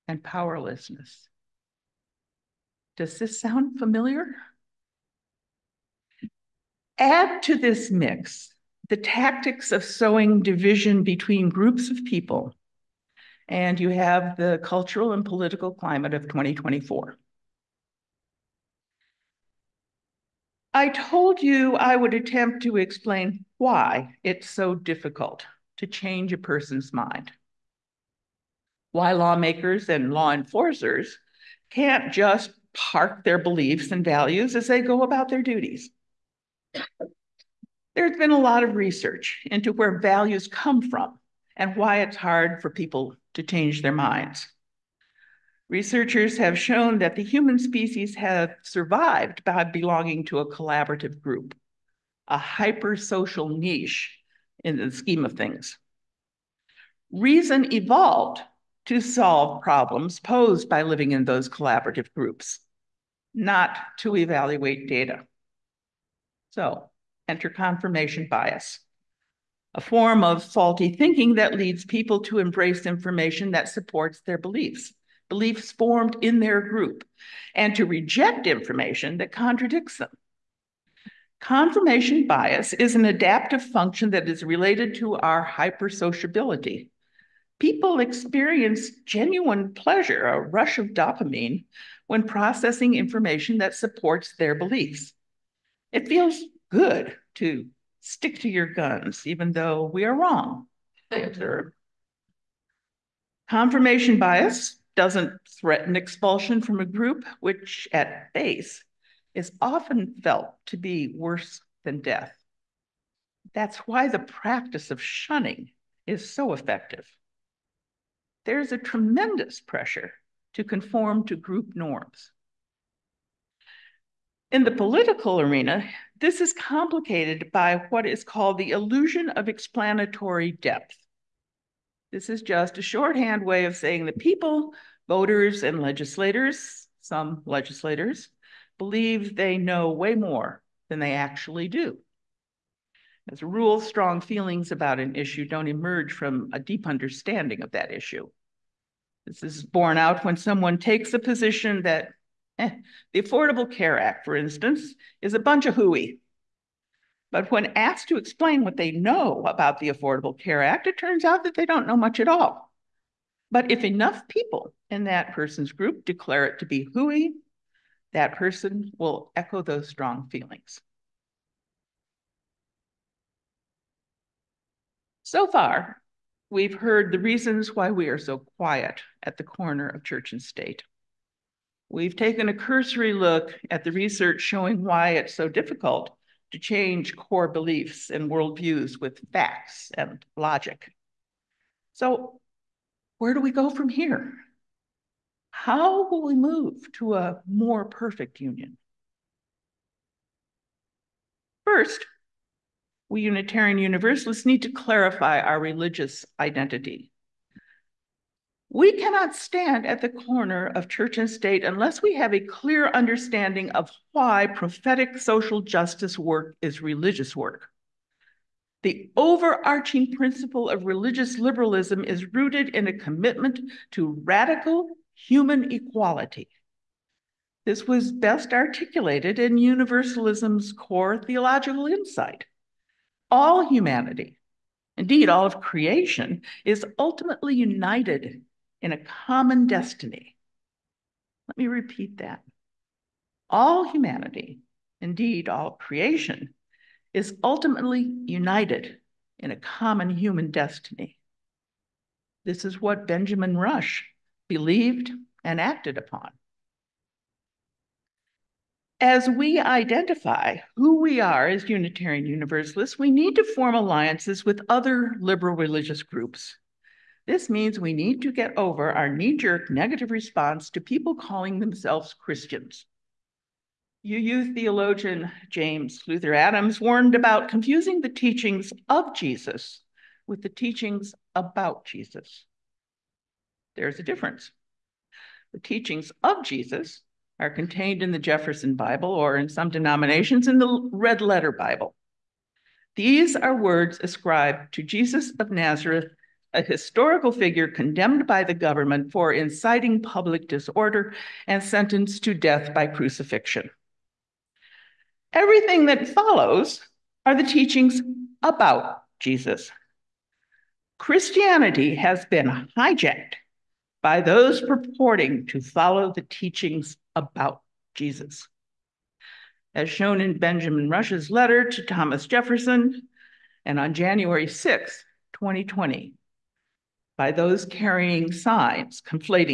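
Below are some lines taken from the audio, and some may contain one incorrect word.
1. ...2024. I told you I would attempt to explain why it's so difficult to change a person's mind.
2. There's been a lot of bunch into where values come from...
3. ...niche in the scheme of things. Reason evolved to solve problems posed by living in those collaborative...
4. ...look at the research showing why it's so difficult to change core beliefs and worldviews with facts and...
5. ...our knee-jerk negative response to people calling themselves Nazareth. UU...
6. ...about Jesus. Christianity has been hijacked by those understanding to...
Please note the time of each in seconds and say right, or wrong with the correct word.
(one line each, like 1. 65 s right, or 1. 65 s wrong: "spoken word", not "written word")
1. 16 s right
2. 37 s wrong: "research", not "bunch"
3. 53 s right
4. 183 s right
5. 268 s wrong: "Christians", not "Nazareth"
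6. 308 s wrong: "purporting", not "understanding".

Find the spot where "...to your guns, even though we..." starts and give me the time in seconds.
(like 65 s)
98 s.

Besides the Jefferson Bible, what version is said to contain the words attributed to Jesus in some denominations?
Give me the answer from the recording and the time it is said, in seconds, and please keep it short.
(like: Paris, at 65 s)
Red Letter Bible, at 290 s.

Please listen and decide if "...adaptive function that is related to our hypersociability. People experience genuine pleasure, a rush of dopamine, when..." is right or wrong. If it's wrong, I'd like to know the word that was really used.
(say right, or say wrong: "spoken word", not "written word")
right.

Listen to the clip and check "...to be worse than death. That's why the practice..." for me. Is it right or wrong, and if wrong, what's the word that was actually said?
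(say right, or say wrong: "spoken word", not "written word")
right.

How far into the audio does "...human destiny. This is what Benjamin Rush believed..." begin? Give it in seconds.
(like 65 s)
250 s.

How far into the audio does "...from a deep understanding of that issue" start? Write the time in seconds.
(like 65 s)
146 s.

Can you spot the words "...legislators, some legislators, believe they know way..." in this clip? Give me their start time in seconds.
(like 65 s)
135 s.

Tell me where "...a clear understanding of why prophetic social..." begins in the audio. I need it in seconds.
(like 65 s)
212 s.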